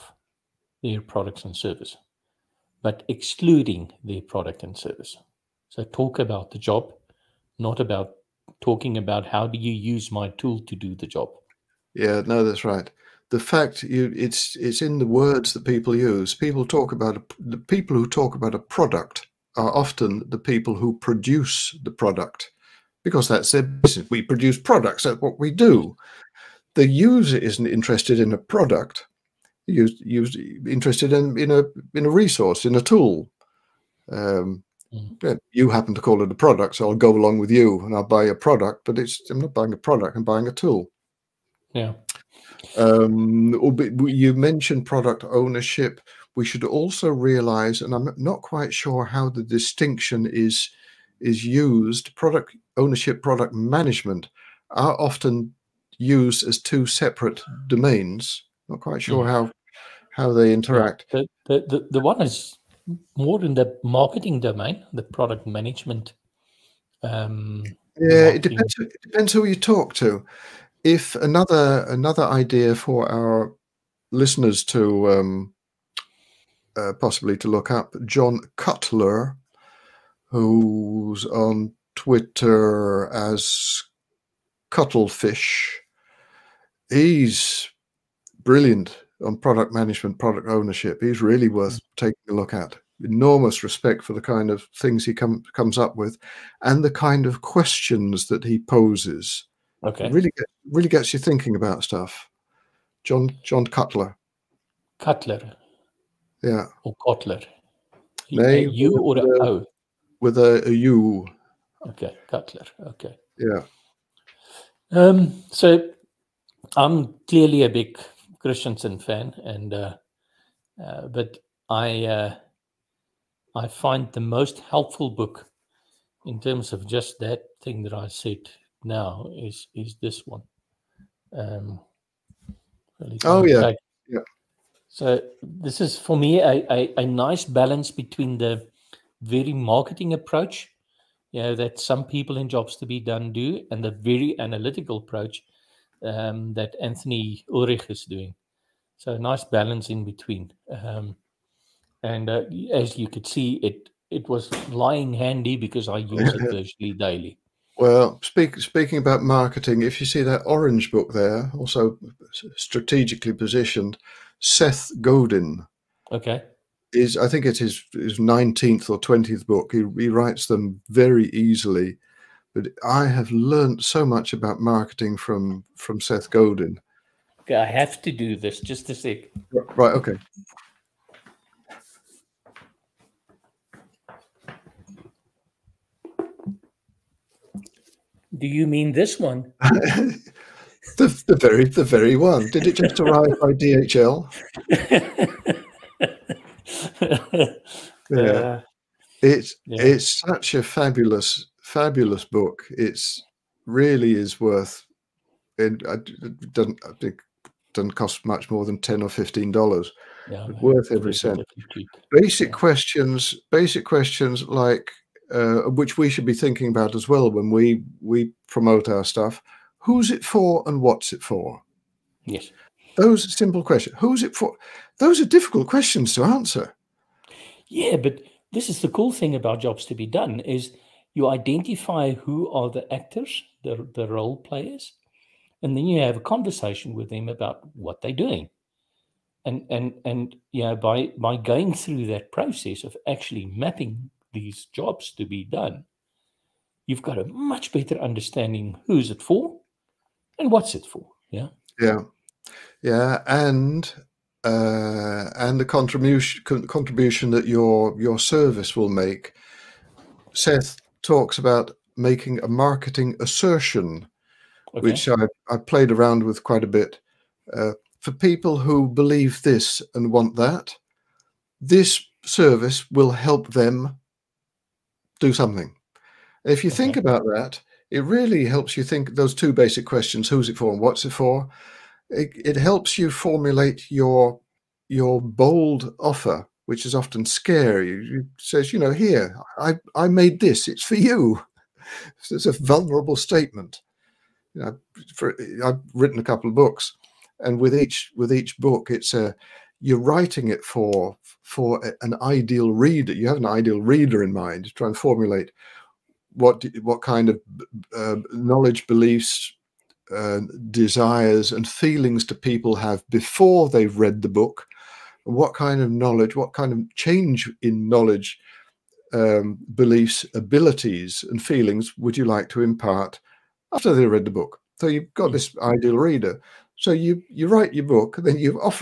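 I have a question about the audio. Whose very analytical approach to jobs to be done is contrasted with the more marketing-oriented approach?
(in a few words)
Anthony Ulwick.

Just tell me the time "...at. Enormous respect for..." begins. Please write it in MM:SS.
01:32.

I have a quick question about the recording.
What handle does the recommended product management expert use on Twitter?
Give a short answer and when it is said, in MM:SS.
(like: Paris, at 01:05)
Cuttlefish, at 01:24.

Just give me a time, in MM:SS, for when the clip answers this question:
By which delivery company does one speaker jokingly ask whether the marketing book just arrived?
03:13.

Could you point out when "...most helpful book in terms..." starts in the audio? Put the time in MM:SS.
02:04.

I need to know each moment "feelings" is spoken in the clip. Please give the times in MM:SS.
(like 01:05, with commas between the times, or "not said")
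05:11, 05:21.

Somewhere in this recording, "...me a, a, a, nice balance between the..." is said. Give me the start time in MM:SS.
02:16.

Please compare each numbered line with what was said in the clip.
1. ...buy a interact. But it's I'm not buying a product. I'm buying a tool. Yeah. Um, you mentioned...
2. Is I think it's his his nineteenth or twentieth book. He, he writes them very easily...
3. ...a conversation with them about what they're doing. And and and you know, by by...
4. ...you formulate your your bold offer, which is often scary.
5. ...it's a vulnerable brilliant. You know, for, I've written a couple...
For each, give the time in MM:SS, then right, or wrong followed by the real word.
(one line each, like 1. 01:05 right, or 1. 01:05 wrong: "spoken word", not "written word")
1. 00:38 wrong: "product", not "interact"
2. 02:46 right
3. 03:56 right
4. 04:42 right
5. 04:52 wrong: "statement", not "brilliant".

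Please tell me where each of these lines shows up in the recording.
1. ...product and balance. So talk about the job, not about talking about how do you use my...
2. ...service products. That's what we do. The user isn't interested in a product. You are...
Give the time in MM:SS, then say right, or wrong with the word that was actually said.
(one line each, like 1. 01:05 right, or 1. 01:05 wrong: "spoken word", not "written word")
1. 00:04 wrong: "service", not "balance"
2. 00:24 wrong: "produce", not "service".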